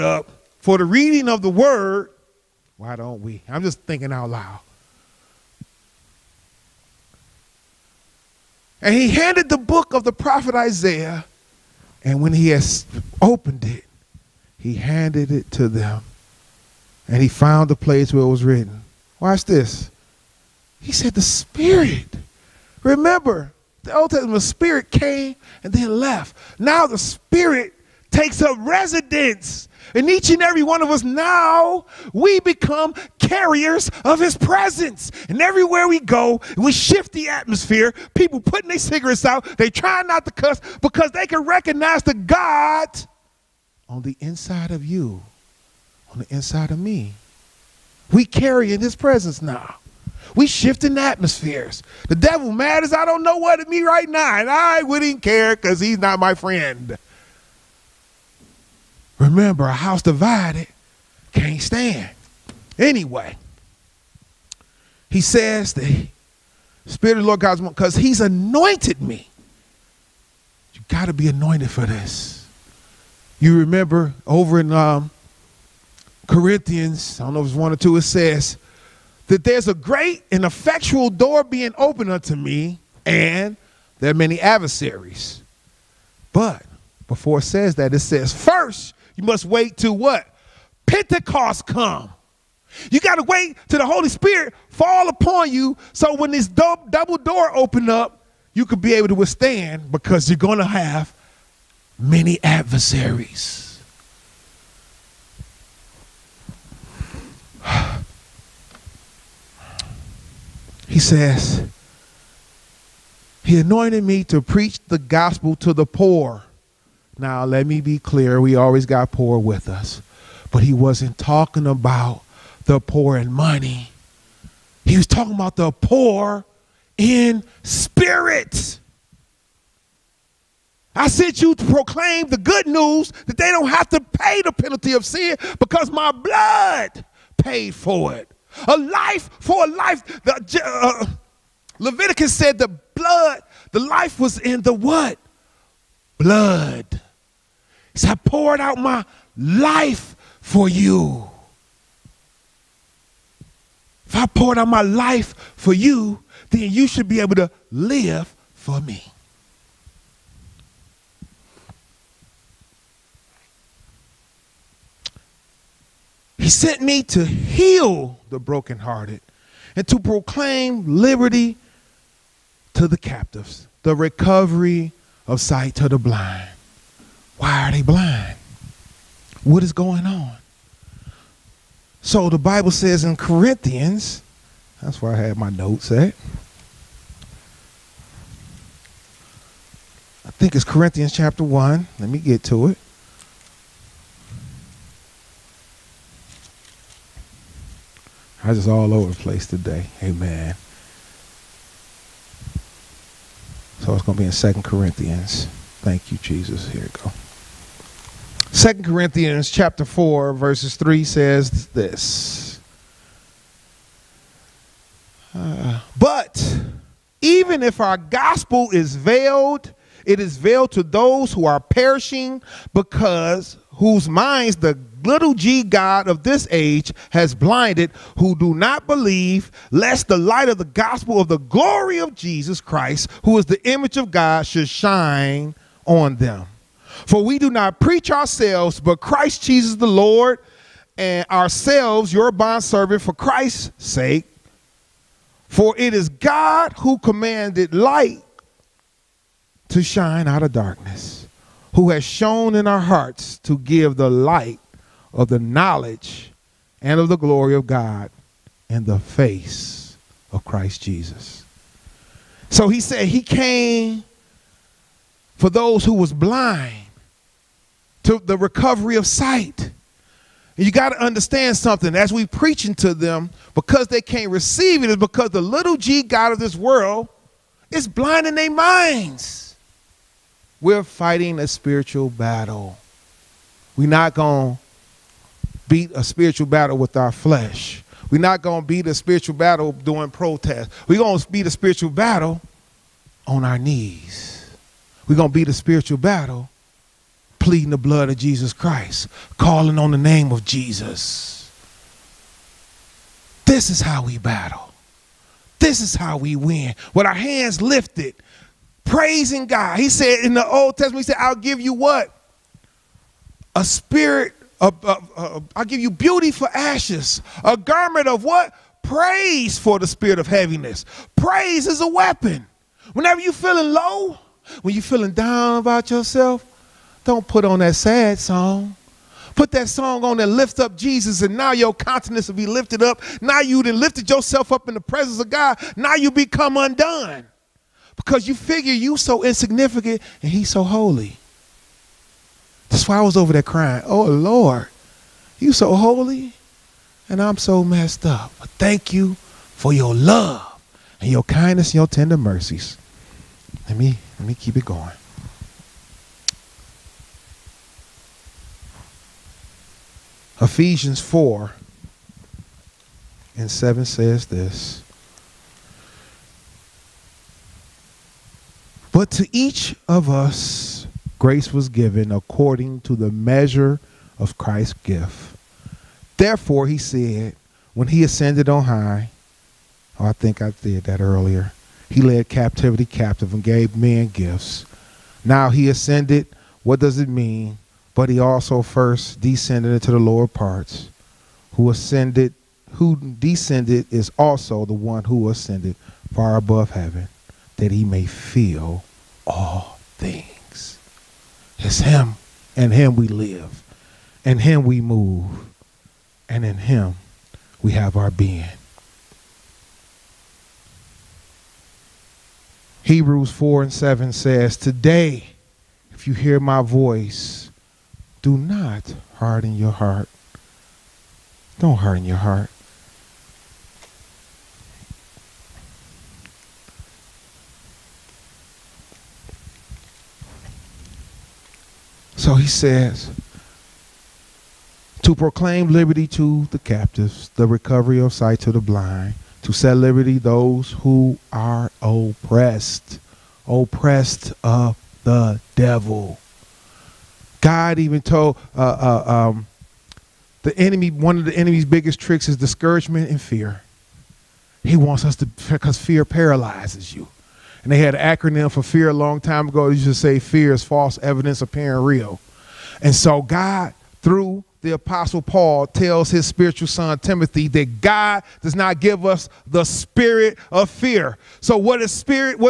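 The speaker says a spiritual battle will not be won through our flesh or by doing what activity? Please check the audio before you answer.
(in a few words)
Protest.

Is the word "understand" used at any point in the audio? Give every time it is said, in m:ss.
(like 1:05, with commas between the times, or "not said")
4:31.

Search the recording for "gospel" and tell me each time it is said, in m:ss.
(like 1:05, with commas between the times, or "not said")
1:54, 3:37, 3:50.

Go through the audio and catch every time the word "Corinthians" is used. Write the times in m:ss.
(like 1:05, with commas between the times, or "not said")
1:16, 3:03, 3:10, 3:24, 3:28.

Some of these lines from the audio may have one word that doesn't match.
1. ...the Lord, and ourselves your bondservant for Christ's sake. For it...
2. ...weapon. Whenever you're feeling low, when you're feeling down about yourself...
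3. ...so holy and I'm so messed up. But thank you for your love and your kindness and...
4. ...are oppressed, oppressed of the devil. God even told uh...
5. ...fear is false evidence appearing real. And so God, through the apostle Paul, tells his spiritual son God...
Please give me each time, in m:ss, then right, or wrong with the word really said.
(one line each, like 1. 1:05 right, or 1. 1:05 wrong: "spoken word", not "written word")
1. 3:59 right
2. 5:21 right
3. 5:45 right
4. 7:21 right
5. 7:40 wrong: "Timothy", not "God".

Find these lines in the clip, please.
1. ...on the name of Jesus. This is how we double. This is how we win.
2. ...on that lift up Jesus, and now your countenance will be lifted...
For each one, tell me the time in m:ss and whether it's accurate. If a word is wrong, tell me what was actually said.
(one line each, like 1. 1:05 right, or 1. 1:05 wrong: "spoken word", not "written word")
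1. 4:59 wrong: "battle", not "double"
2. 5:30 right.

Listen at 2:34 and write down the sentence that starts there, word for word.
If I poured out my life for you, then you should be able to live for me.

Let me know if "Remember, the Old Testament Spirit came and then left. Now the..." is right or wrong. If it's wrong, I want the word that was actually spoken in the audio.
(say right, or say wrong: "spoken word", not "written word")
right.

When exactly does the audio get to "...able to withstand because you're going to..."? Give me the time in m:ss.
1:38.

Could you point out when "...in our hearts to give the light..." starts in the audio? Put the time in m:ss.
4:12.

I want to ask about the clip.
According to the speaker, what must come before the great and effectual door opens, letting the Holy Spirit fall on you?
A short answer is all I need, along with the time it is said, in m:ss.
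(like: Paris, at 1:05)
Pentecost, at 1:30.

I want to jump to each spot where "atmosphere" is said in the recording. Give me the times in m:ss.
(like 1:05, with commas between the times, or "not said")
0:37, 0:50.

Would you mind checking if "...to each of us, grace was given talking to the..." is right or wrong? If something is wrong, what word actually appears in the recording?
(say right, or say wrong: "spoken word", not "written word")
wrong: "according", not "talking".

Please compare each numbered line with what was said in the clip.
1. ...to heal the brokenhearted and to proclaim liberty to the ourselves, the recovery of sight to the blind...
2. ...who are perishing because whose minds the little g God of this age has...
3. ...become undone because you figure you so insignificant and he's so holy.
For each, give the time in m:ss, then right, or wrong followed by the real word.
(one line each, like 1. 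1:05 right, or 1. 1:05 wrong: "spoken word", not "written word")
1. 2:47 wrong: "captives", not "ourselves"
2. 3:41 right
3. 5:36 right.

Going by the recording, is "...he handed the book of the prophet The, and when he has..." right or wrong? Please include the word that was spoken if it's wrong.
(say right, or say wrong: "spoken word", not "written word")
wrong: "Isaiah", not "The".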